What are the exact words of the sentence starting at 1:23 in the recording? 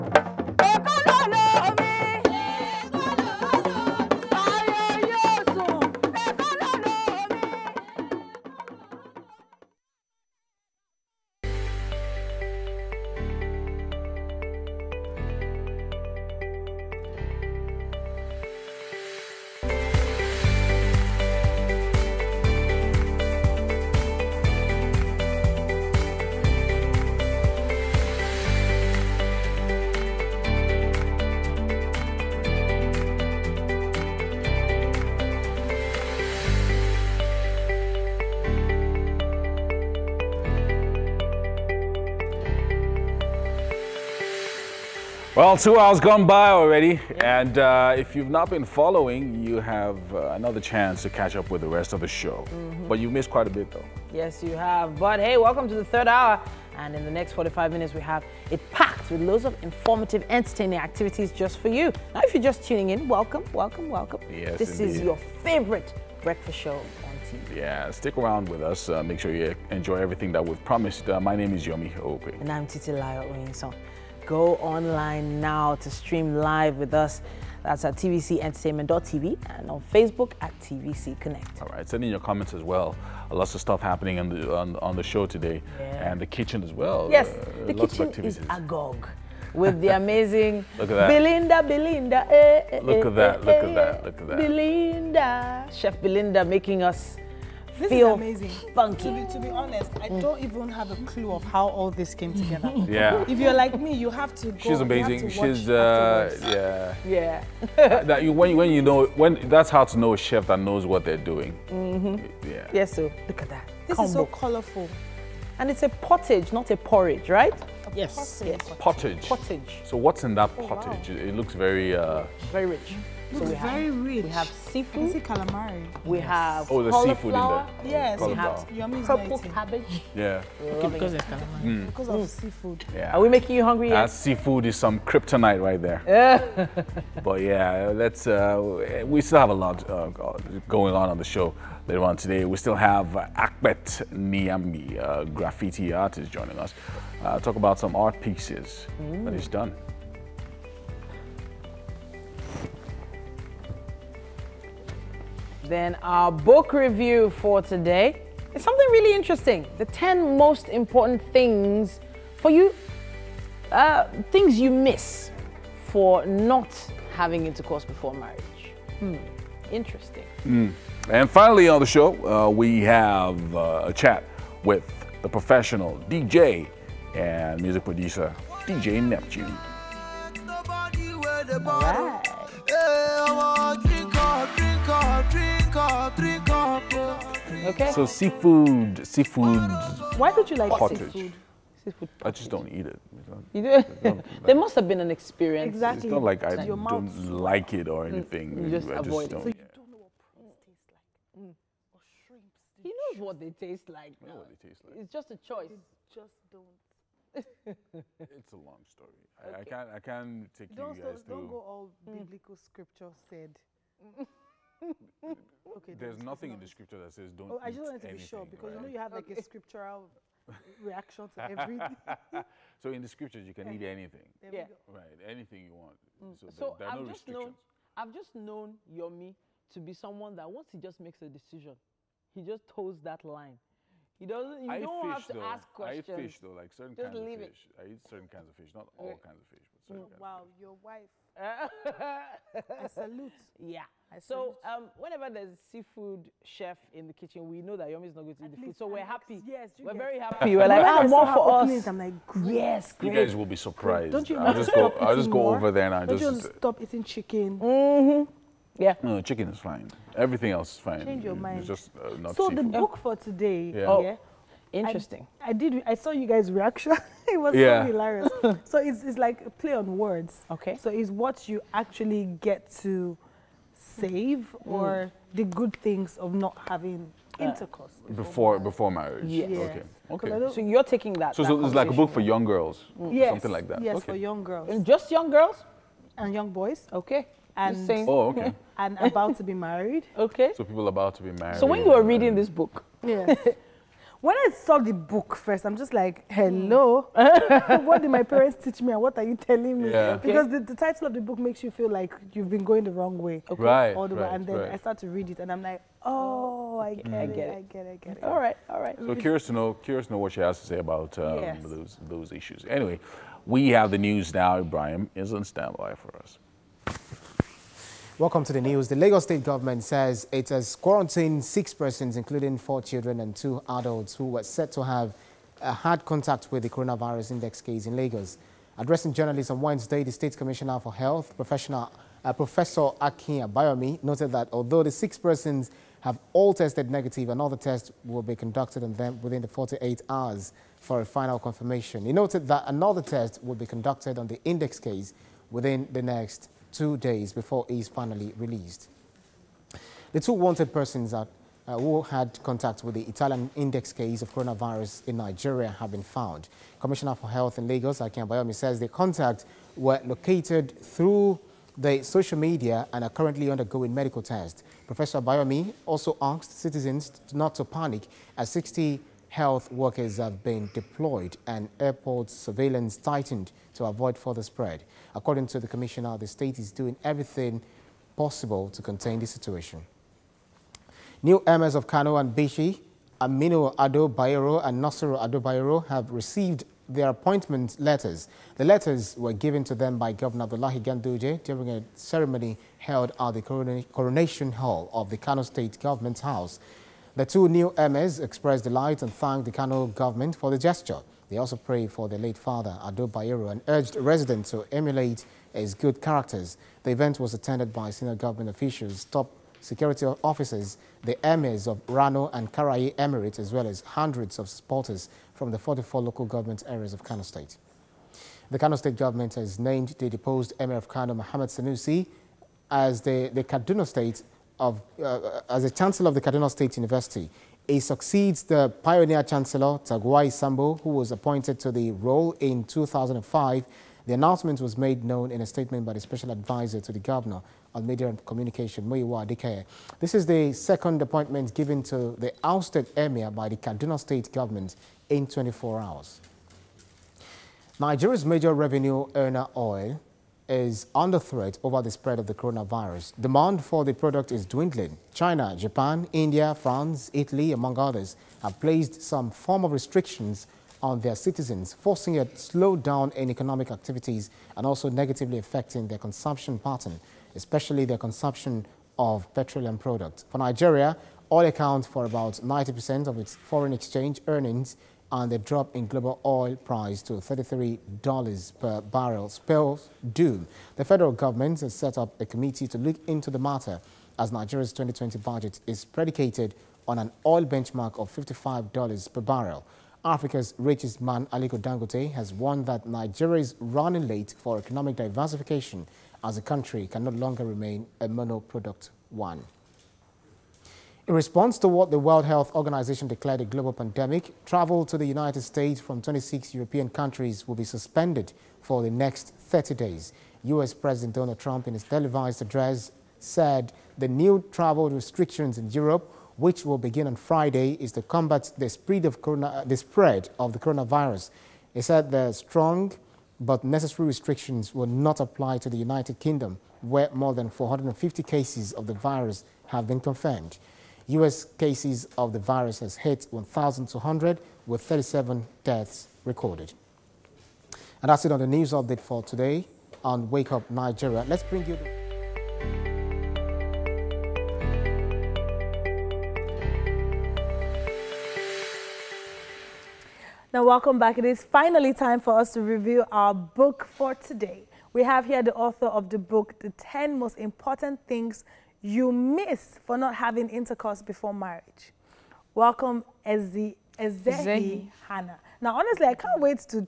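Lots of stuff happening on the, on, on the show today yeah.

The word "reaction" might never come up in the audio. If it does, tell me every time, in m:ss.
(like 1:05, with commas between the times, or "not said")
3:40, 4:26.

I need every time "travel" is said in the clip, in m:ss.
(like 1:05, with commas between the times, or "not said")
8:24, 8:34.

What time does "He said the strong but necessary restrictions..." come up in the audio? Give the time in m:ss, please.
8:41.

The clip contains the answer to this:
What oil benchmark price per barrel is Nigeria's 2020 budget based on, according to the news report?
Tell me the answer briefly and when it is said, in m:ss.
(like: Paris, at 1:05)
$55, at 8:08.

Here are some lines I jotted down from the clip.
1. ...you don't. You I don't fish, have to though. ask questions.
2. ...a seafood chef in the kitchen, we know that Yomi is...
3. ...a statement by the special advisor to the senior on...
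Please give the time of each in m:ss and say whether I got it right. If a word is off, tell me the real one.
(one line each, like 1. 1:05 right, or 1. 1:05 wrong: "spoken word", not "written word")
1. 3:54 right
2. 4:05 right
3. 7:15 wrong: "governor", not "senior".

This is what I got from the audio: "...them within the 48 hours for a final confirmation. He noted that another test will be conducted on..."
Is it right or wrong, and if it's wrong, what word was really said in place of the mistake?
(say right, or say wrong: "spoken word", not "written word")
right.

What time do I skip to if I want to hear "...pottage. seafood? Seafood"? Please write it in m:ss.
3:10.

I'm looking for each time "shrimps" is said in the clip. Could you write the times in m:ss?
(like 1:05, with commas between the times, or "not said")
3:22.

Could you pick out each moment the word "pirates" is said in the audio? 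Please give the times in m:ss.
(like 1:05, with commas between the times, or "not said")
not said.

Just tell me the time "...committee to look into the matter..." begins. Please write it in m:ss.
8:02.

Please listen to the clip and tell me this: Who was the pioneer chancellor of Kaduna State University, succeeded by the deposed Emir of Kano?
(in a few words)
Tagwai Sambo.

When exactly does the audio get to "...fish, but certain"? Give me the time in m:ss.
3:59.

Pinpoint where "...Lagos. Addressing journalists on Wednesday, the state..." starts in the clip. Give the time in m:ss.
5:27.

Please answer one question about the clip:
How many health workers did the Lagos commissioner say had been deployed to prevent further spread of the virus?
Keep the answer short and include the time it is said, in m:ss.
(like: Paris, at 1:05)
60, at 6:08.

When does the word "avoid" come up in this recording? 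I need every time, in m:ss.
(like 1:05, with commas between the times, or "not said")
3:19, 6:13.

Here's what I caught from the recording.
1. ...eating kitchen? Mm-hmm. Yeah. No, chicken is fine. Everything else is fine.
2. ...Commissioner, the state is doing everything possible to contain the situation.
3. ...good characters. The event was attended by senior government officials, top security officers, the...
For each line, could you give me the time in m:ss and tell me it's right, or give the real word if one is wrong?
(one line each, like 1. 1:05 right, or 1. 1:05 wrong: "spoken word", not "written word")
1. 4:16 wrong: "chicken", not "kitchen"
2. 6:15 right
3. 6:45 right.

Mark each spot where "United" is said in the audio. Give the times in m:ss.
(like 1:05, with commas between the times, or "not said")
8:25, 8:45.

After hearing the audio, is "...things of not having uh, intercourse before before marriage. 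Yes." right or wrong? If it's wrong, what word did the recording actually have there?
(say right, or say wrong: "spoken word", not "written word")
right.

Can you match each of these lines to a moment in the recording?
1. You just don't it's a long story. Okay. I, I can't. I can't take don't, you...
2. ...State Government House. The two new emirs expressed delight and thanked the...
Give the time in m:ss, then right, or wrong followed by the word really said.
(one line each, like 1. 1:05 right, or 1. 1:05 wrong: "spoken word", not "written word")
1. 3:25 right
2. 6:35 right.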